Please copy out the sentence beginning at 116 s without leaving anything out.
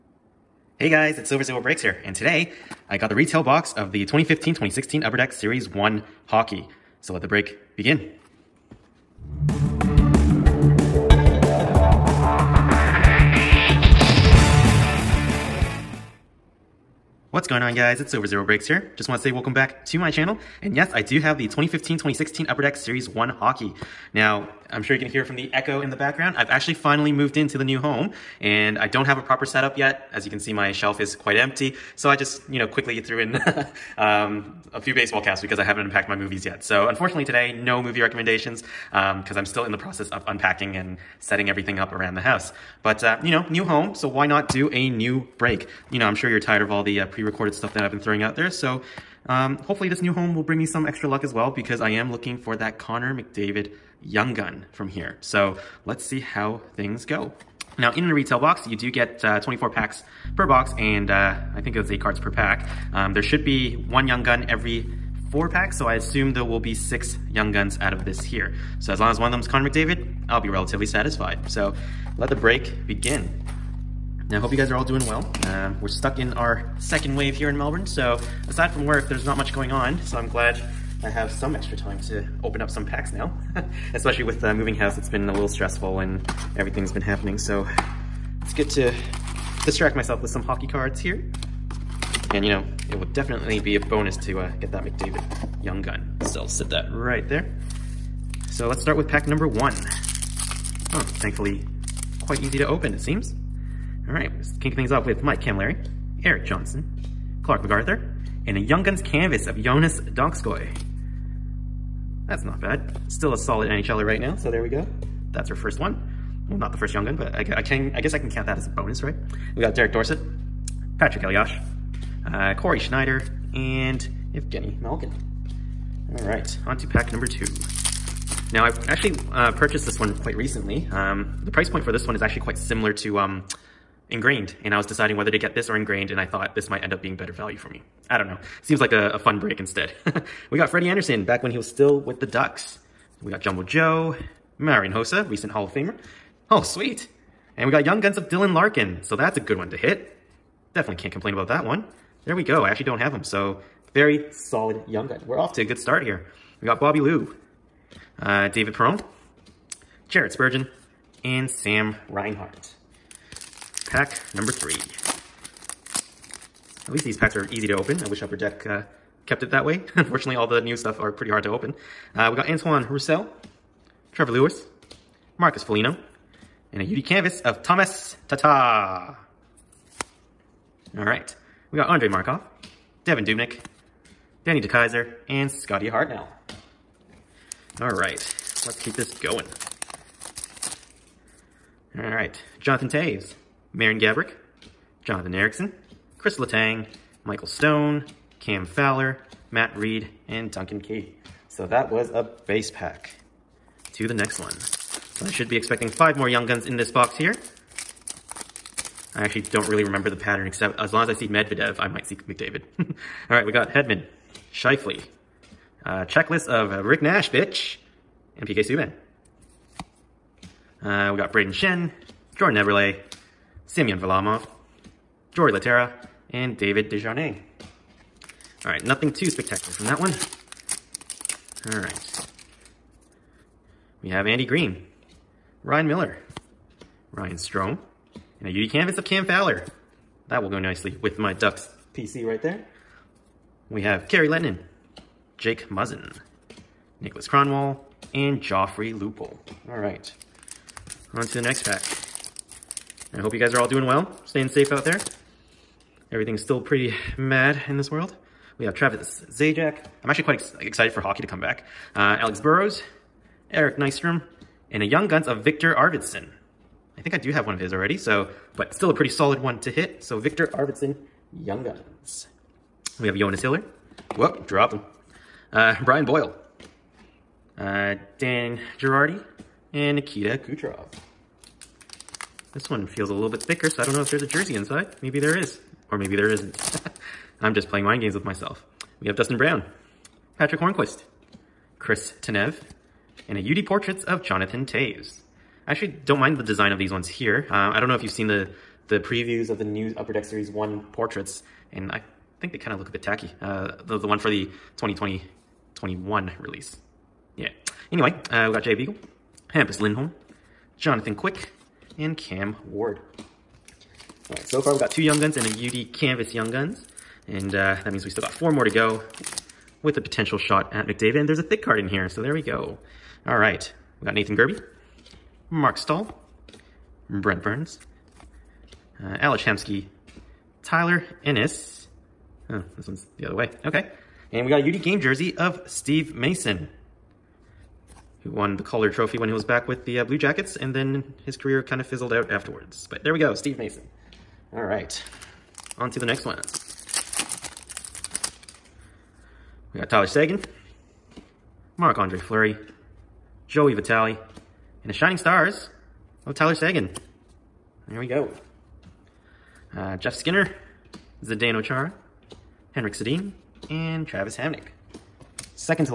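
Well, not the first Young Gun, but I, I, can, I guess I can count that as a bonus, right?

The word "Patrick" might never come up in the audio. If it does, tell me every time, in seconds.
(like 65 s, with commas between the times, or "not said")
120 s, 290 s.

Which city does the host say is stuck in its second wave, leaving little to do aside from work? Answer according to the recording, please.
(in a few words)
Melbourne.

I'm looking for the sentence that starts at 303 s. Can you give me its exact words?
Uh, the, the one for the 2020-21 release.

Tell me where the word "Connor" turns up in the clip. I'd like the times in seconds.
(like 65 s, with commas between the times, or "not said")
52 s, 69 s.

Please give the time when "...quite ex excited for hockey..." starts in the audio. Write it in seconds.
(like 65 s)
260 s.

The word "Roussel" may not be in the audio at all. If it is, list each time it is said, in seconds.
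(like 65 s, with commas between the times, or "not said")
172 s.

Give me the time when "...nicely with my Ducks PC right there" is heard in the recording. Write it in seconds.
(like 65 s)
240 s.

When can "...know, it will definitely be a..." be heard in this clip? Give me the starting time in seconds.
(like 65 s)
92 s.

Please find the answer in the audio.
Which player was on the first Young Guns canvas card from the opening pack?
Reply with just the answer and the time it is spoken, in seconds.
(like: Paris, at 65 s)
Jonas Donskoi, at 109 s.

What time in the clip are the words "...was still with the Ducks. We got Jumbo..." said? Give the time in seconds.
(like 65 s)
141 s.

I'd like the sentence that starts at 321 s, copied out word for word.
And there's a thick card in here, so there we go.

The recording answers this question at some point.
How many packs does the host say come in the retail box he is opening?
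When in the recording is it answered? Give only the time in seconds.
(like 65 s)
59 s.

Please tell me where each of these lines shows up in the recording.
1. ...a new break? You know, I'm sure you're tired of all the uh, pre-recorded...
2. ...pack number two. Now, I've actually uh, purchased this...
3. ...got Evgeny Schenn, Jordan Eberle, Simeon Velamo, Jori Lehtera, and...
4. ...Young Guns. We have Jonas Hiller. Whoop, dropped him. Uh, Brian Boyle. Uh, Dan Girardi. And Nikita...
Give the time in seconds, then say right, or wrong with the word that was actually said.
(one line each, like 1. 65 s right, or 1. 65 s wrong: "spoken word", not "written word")
1. 44 s right
2. 126 s right
3. 221 s wrong: "Brayden", not "Evgeny"
4. 271 s right.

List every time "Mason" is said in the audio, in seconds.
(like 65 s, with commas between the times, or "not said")
336 s, 343 s.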